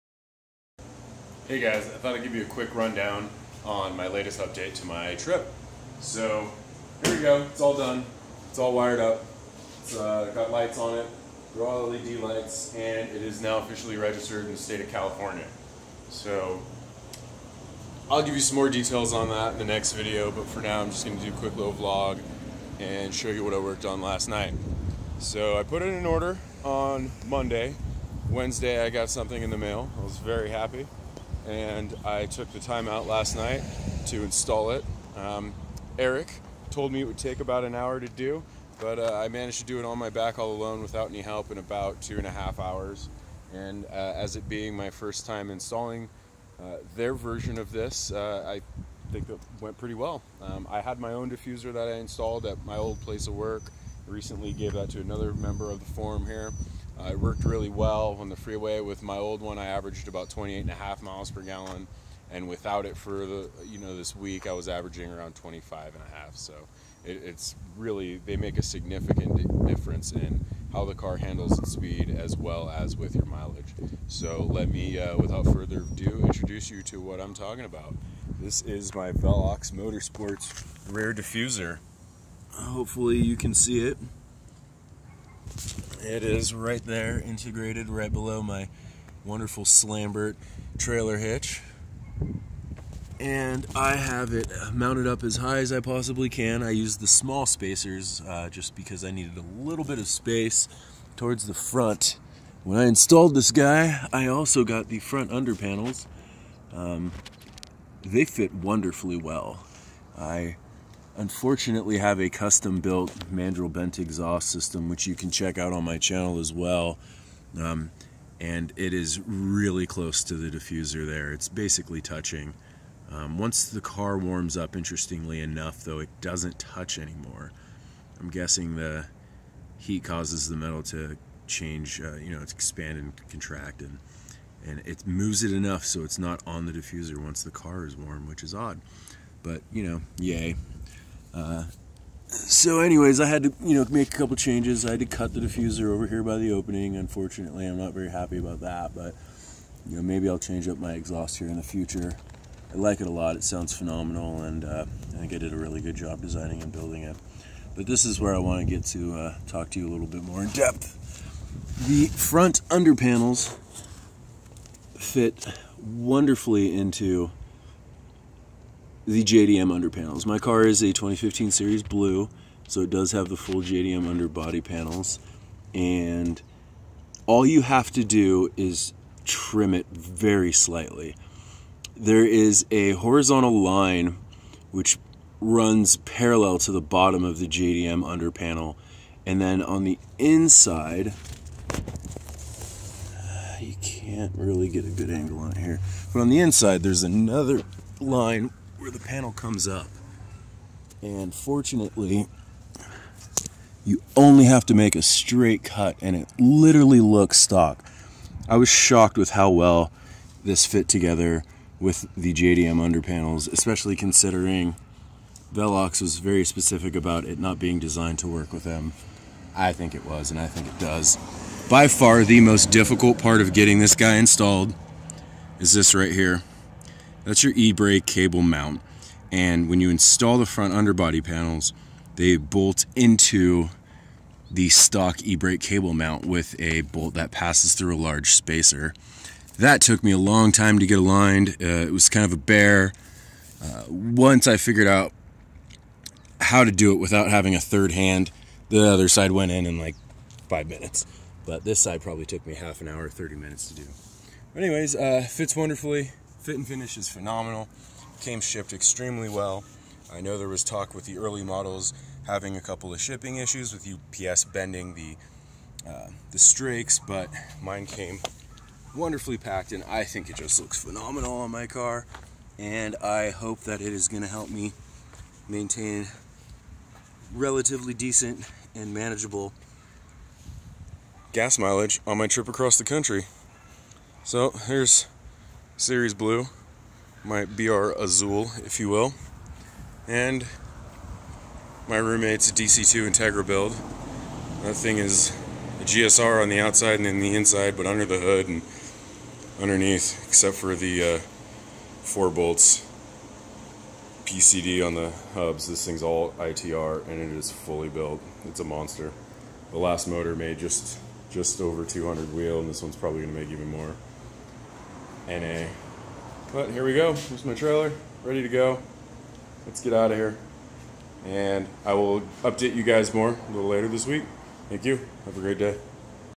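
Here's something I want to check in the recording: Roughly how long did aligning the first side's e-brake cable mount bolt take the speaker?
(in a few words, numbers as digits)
30 minutes.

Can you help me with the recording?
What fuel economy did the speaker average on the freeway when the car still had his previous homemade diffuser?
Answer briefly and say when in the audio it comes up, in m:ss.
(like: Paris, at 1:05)
28.5 mpg, at 1:00.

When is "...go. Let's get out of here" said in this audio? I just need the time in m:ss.
5:18.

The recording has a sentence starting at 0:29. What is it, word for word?
I was very happy and I took the time out last night to install it.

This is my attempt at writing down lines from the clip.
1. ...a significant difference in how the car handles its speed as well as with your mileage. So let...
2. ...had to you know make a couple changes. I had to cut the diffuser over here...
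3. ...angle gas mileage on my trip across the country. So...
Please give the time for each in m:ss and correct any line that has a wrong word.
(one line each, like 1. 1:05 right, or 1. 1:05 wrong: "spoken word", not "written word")
1. 1:08 right
2. 2:23 right
3. 4:38 wrong: "manageable", not "angle".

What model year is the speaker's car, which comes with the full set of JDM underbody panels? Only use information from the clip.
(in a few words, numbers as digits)
2015.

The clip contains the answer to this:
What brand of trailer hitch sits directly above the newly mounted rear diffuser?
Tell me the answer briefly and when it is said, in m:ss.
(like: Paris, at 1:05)
Slambert, at 1:29.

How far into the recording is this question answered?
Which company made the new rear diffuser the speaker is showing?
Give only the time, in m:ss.
1:19.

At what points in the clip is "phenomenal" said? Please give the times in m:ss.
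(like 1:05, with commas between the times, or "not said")
2:33, 4:17, 4:30.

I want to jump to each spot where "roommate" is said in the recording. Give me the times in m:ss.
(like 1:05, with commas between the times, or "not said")
4:51.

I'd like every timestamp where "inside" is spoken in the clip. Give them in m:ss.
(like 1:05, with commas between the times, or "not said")
3:10, 3:16, 4:57.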